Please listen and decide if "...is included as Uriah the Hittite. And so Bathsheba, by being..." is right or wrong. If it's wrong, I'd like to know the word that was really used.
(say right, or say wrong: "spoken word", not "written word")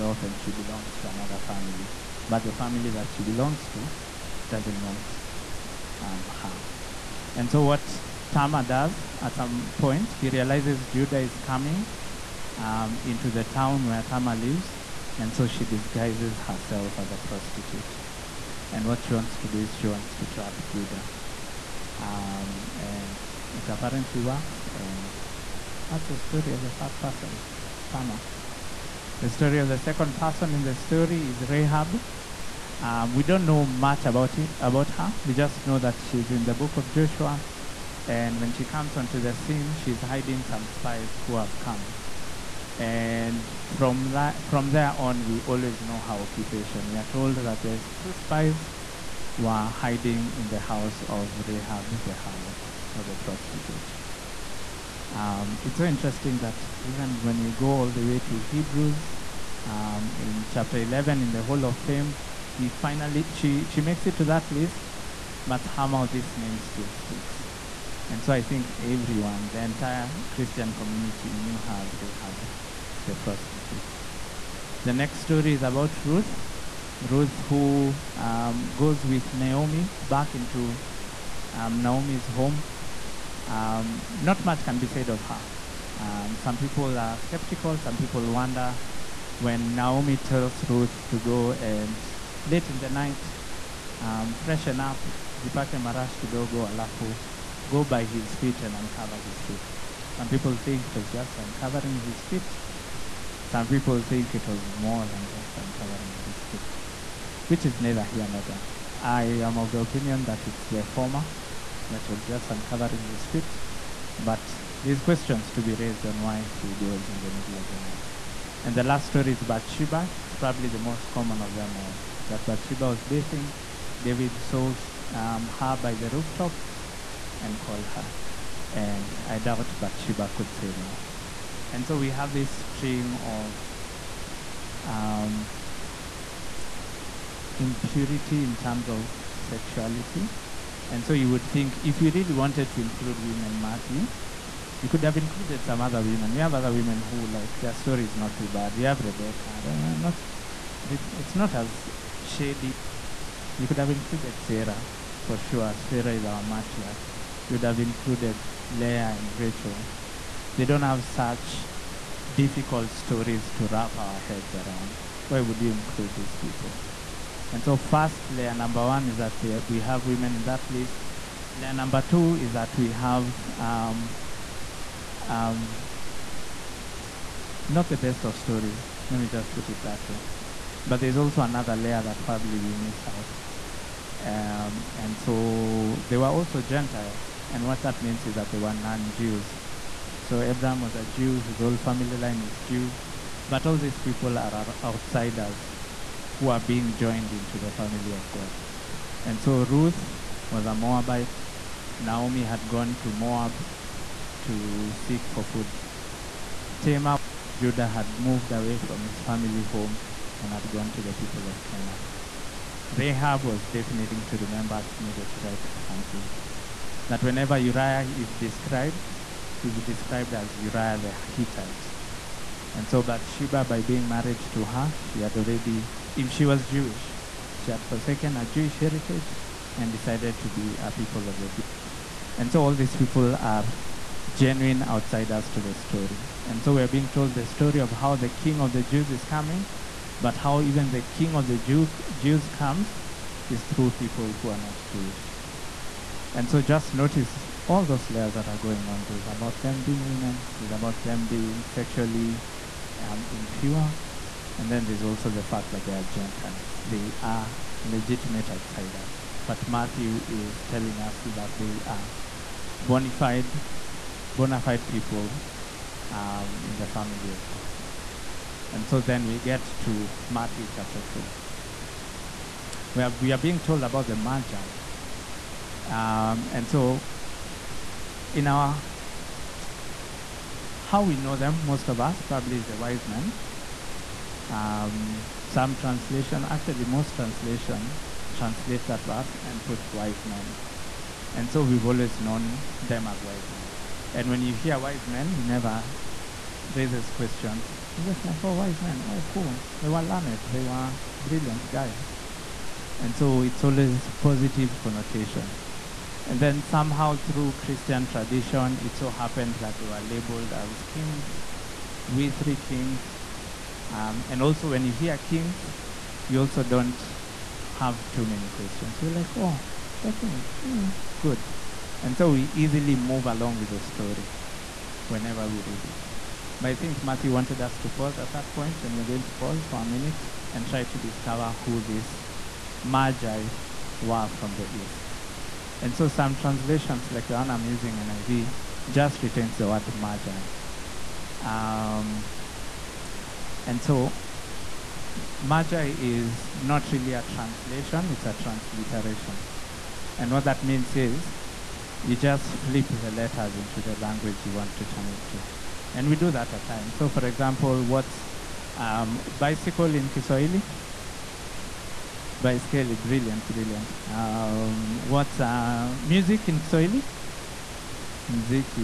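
wrong: "described", not "included".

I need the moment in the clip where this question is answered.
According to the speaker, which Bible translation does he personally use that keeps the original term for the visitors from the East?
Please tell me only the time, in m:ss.
5:37.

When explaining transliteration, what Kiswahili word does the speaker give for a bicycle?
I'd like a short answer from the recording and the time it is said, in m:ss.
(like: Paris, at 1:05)
Baiskeli, at 6:02.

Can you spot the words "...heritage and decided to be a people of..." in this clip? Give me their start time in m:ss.
3:48.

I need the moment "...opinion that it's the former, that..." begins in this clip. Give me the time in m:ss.
1:49.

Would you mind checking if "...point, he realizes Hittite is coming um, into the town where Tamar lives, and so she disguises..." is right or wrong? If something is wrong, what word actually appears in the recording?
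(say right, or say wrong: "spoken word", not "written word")
wrong: "Judah", not "Hittite".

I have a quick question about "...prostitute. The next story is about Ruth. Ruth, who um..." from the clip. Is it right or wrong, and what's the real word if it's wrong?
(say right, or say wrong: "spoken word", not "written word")
right.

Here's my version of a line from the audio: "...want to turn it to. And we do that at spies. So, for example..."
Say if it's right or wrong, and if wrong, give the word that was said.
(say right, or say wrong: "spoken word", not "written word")
wrong: "times", not "spies".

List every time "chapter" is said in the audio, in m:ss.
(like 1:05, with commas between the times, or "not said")
1:00, 4:30.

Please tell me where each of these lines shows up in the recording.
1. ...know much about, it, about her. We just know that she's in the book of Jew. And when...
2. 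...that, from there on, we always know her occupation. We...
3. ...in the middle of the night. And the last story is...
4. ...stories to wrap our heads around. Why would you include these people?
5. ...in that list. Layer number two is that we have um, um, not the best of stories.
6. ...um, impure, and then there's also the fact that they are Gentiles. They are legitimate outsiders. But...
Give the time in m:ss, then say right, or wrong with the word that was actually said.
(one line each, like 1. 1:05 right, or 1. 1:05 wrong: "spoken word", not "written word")
1. 0:33 wrong: "Joshua", not "Jew"
2. 0:44 right
3. 1:57 right
4. 2:42 right
5. 2:50 right
6. 4:12 right.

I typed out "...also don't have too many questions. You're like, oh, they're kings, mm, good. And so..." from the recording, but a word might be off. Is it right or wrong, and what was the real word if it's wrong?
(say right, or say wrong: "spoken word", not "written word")
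right.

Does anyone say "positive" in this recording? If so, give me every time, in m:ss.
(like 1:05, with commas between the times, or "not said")
5:04.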